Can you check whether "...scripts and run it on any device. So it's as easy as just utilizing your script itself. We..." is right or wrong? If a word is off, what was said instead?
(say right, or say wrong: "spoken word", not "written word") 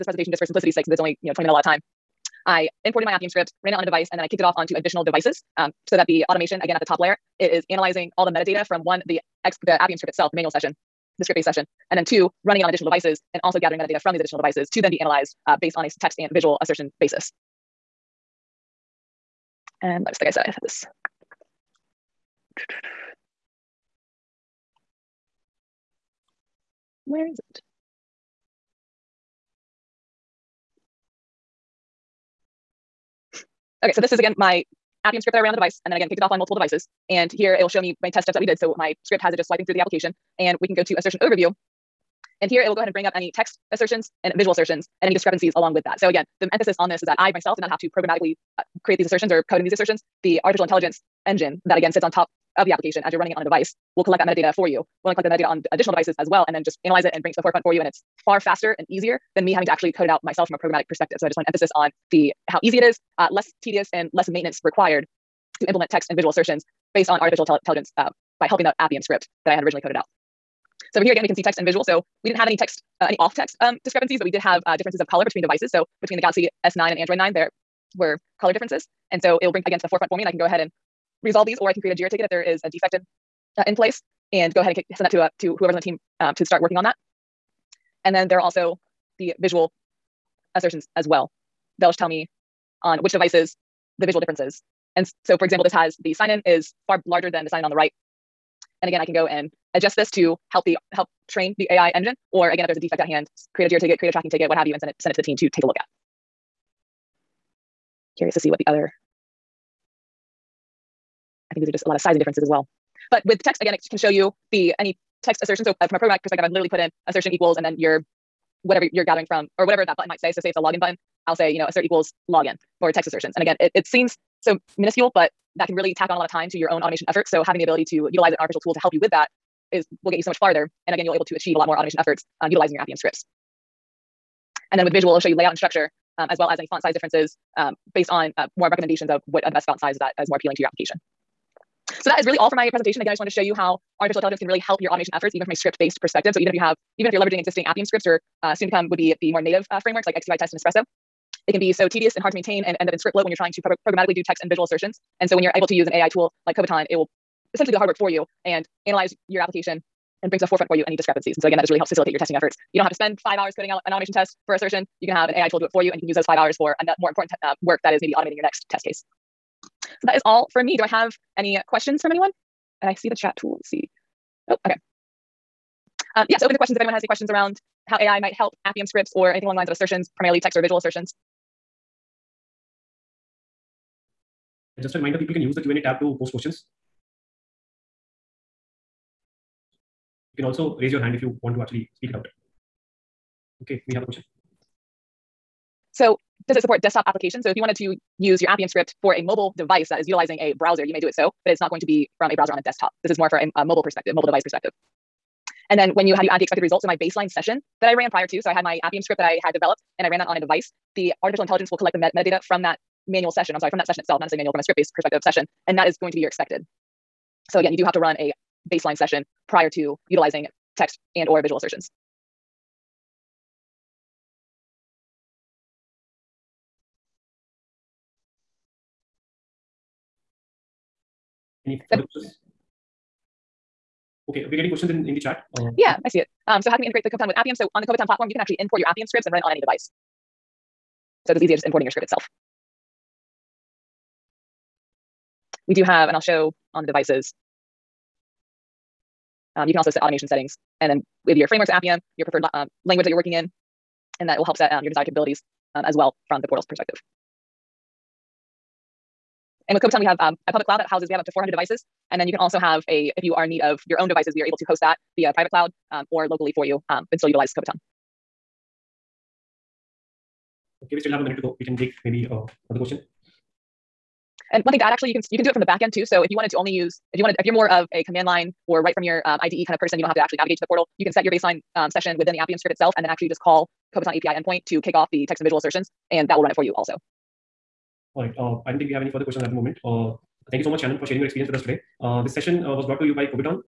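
wrong: "importing", not "utilizing".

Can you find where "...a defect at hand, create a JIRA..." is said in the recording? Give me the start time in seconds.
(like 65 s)
102 s.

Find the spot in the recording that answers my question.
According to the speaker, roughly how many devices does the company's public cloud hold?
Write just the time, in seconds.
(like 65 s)
261 s.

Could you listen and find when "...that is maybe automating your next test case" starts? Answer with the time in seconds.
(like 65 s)
167 s.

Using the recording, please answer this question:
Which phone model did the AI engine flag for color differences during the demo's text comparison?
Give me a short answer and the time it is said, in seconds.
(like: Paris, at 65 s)
Galaxy S9, at 76 s.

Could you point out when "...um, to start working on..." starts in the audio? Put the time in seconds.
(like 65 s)
86 s.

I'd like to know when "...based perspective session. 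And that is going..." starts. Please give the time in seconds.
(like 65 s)
214 s.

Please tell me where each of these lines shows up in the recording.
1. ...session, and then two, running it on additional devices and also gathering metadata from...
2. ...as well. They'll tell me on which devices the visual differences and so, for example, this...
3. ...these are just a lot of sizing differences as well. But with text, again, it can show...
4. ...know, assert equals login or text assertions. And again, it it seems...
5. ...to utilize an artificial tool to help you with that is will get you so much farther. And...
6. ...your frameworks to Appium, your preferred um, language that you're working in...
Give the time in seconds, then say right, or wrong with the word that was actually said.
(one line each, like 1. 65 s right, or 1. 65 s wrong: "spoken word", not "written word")
1. 11 s right
2. 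90 s right
3. 111 s right
4. 121 s right
5. 127 s right
6. 251 s right.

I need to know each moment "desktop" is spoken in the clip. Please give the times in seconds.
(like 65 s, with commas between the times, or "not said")
196 s, 202 s.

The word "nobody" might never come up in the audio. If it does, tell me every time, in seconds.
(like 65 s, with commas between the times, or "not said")
not said.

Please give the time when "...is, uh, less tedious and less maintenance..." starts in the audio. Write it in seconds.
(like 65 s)
62 s.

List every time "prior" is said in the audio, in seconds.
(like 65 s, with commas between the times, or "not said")
208 s, 219 s.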